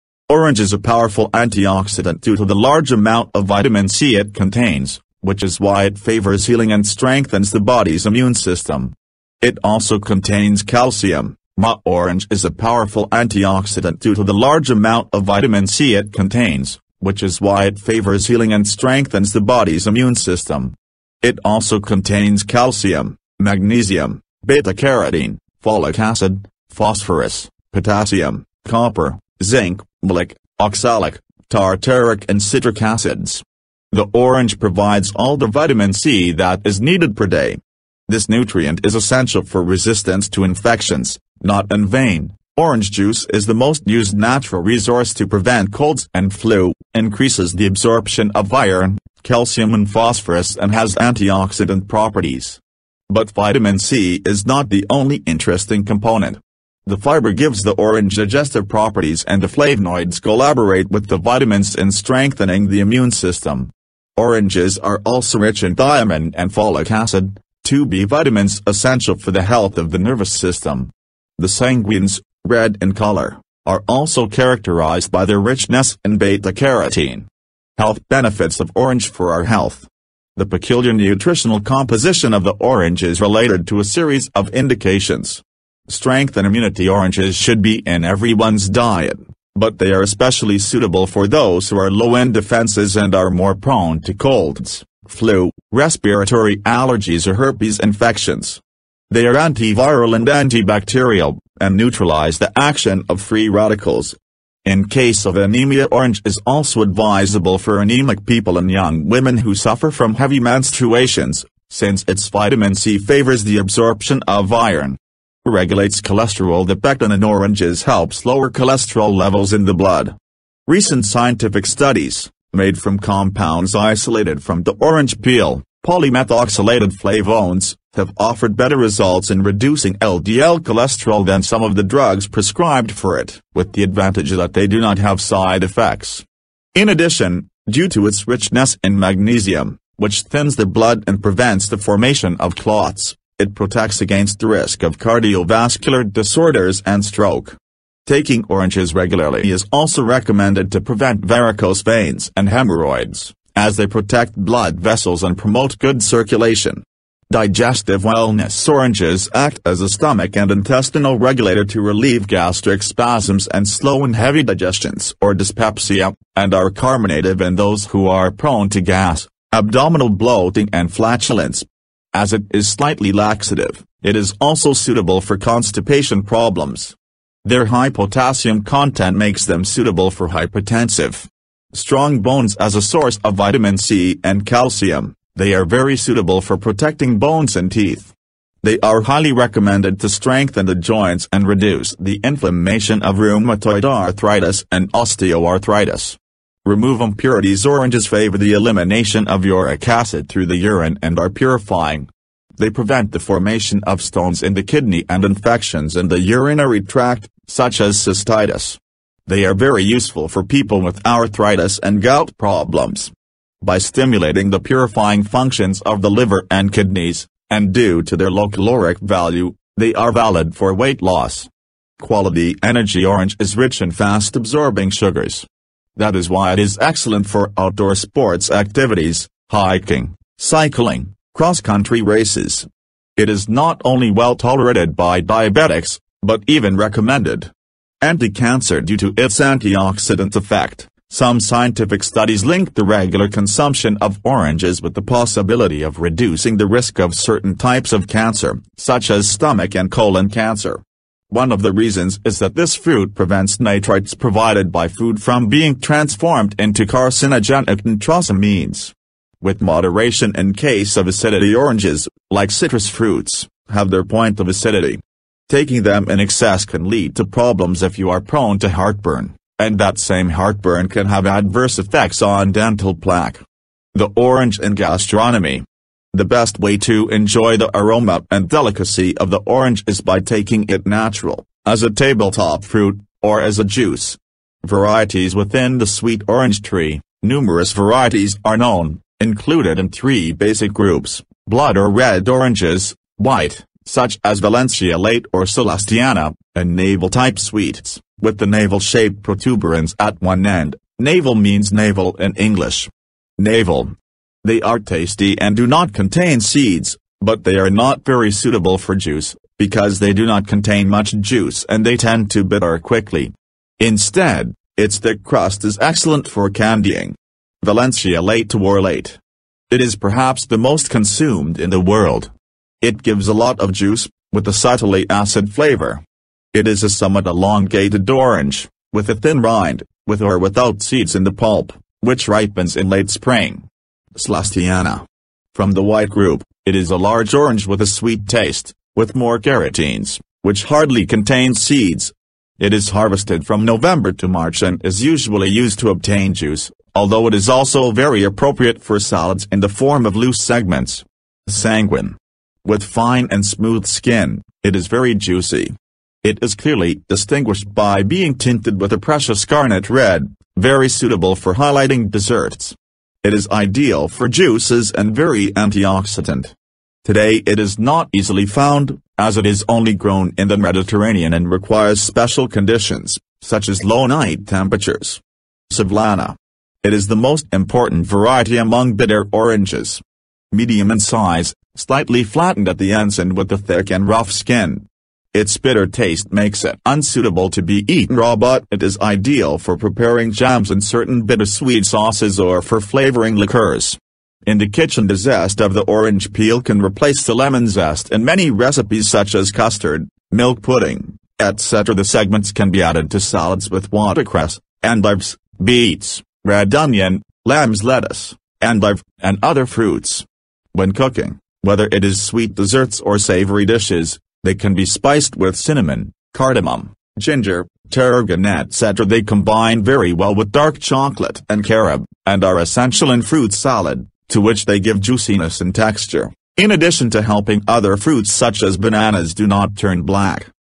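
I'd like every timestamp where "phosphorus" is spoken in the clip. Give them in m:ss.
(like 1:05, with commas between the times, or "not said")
0:26, 0:49.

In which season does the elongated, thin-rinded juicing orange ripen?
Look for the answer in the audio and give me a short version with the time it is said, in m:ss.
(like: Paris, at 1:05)
late spring, at 5:32.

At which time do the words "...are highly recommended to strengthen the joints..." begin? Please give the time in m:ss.
3:08.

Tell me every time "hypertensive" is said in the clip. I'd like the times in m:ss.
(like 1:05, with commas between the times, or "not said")
3:00.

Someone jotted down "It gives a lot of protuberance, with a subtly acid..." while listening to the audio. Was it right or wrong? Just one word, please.
wrong.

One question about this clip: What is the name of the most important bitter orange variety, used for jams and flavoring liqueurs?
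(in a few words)
Sevillana.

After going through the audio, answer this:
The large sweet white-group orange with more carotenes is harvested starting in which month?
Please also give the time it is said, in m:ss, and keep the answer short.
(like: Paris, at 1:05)
November, at 5:43.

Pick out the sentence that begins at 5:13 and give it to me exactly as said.
Instead, its thick crust is excellent for candying.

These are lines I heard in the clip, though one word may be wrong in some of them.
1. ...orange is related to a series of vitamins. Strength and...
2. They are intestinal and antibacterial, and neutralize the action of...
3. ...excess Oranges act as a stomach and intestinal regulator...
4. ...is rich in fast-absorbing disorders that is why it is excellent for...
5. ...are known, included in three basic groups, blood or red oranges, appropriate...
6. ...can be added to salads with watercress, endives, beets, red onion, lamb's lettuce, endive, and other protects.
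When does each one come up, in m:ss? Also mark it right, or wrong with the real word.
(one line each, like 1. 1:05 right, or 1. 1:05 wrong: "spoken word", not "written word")
1. 1:22 wrong: "indications", not "vitamins"
2. 1:39 wrong: "antiviral", not "intestinal"
3. 2:38 wrong: "wellness", not "excess"
4. 3:43 wrong: "sugars", not "disorders"
5. 4:48 wrong: "white", not "appropriate"
6. 6:42 wrong: "fruits", not "protects".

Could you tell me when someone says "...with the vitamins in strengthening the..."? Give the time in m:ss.
1:00.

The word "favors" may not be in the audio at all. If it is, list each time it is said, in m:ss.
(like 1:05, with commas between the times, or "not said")
0:05, 0:17, 1:52, 3:18.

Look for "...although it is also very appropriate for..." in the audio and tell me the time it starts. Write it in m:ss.
5:46.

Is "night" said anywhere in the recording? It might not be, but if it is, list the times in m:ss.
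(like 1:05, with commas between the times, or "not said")
6:14.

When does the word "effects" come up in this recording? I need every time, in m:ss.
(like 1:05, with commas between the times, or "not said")
2:15, 4:00, 4:31.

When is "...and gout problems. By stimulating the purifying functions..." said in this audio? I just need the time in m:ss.
3:31.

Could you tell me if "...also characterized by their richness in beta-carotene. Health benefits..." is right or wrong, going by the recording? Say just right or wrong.
right.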